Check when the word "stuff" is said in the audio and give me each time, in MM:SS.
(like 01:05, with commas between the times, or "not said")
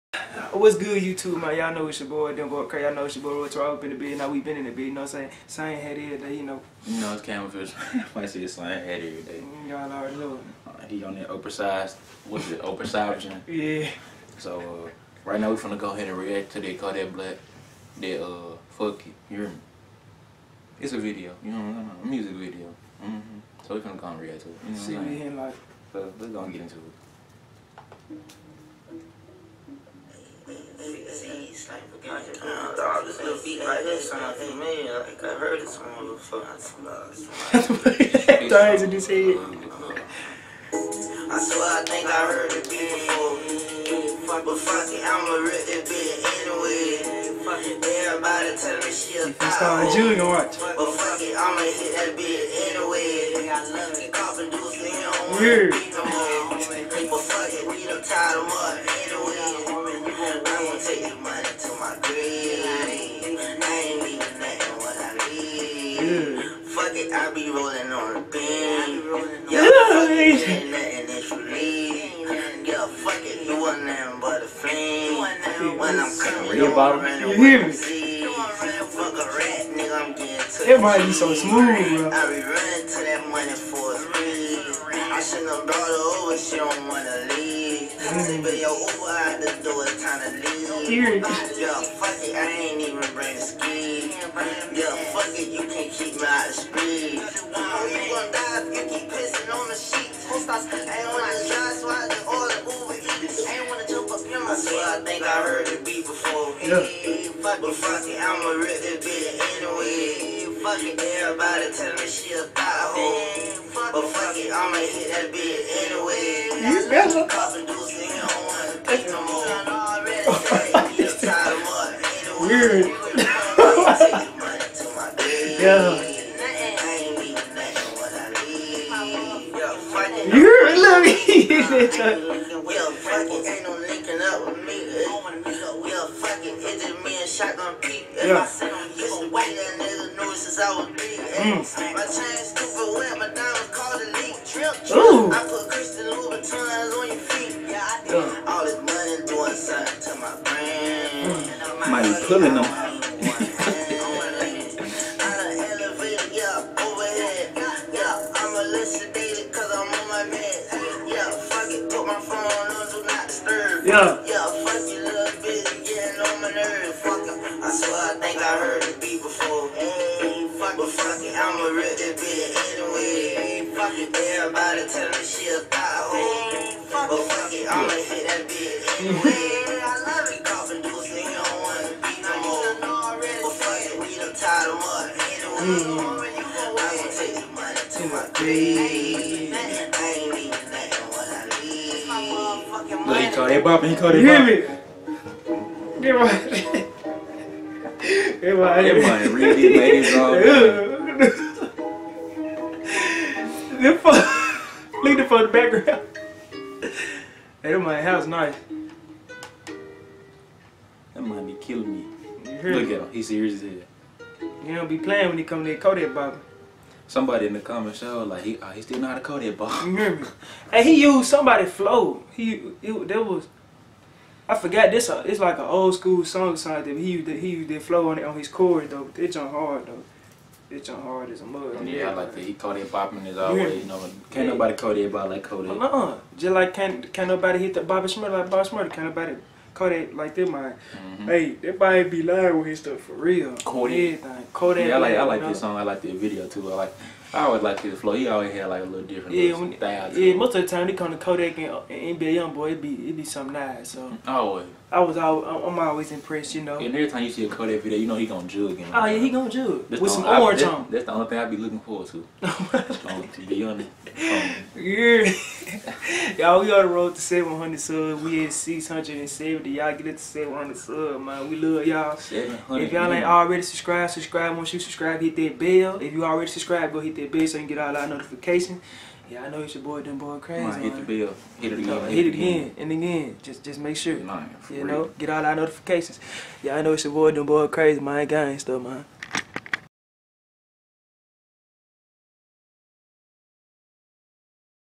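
04:02, 04:48.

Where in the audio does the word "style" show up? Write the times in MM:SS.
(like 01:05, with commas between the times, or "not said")
04:09.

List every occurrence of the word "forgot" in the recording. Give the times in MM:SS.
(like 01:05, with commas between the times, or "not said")
03:44.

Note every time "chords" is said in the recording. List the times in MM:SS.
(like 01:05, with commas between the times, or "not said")
03:48.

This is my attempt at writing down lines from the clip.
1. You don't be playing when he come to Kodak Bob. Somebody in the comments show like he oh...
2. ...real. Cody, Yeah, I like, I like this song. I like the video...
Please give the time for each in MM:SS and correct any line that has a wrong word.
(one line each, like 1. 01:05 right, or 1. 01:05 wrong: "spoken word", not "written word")
1. 03:34 right
2. 04:03 right.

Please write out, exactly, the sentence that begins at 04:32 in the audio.
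If y'all ain't already subscribed, subscribe.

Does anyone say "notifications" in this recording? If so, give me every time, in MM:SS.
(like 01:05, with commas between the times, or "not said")
04:38, 04:45.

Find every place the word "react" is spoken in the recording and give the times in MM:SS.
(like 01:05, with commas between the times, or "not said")
00:16, 00:24.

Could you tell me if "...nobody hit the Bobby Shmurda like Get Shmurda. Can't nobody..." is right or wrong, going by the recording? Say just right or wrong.
wrong.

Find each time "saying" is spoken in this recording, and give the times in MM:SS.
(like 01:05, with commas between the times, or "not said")
00:05, 00:21.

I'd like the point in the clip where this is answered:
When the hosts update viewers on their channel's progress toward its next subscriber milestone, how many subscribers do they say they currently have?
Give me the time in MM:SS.
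04:28.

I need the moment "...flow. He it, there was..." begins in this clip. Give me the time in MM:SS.
03:41.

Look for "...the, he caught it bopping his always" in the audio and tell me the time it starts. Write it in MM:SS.
03:52.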